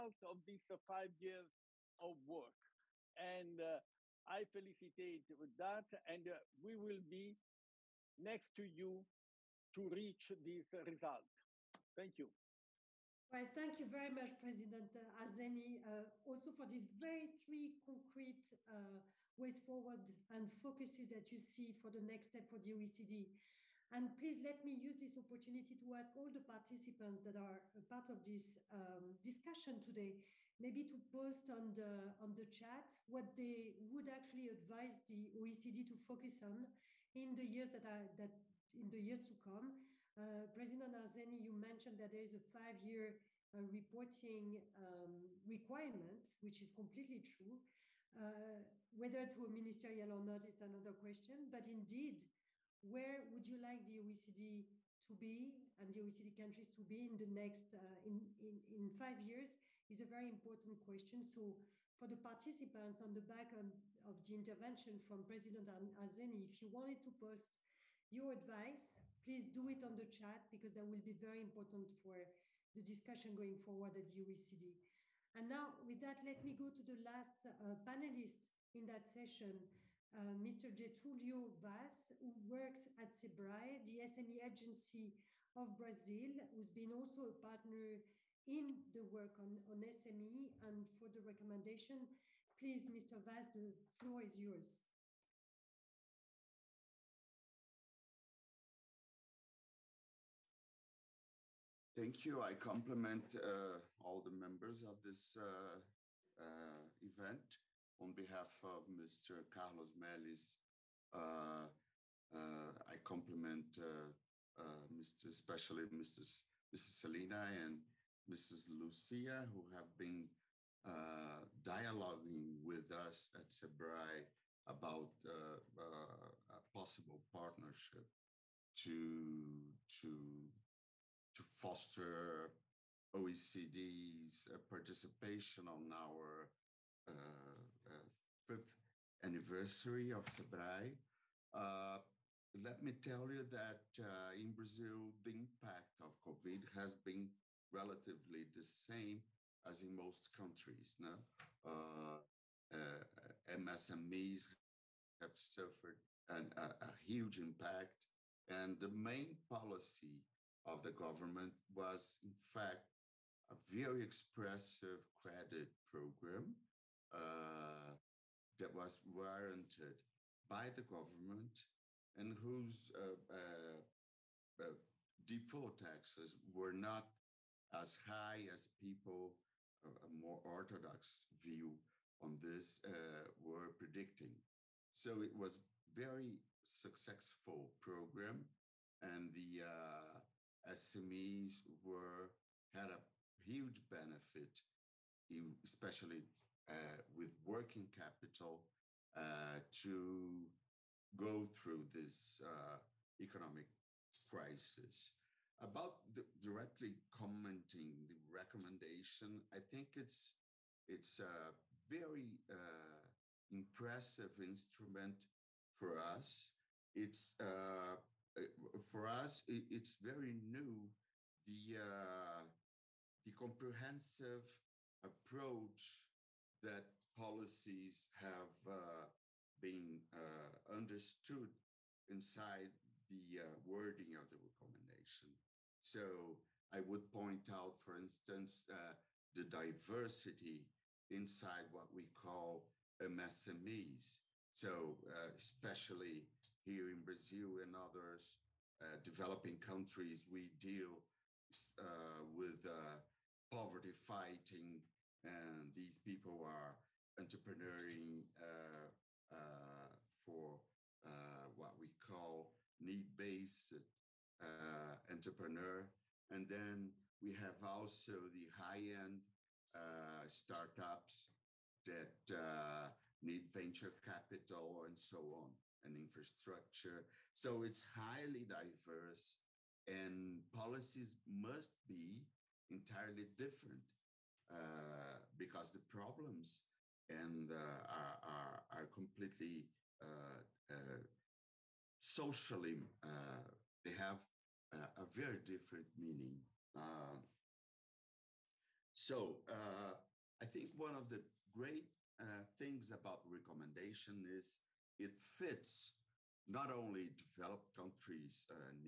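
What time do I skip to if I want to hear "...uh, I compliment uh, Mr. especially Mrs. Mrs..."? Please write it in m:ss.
1:52.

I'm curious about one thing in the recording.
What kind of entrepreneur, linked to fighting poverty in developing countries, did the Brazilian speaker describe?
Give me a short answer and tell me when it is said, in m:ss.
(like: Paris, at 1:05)
need based entrepreneur, at 4:22.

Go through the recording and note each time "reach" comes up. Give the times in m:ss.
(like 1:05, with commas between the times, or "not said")
0:09.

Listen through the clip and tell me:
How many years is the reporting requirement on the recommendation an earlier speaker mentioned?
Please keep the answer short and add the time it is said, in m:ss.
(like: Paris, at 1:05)
5, at 0:42.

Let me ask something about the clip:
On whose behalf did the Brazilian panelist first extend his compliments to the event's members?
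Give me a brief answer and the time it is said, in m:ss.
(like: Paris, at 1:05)
Carlos Melles, at 1:48.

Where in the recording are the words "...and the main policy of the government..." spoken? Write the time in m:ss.
2:38.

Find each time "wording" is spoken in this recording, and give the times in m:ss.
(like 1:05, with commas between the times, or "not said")
3:53.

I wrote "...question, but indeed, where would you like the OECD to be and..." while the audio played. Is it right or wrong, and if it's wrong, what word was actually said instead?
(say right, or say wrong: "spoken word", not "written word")
right.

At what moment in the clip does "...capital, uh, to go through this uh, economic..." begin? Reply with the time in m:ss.
3:17.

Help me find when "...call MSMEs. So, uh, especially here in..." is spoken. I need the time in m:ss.
4:02.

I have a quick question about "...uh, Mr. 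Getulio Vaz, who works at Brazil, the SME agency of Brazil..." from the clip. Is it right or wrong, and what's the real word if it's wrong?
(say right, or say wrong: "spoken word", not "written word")
wrong: "SEBRAE", not "Brazil".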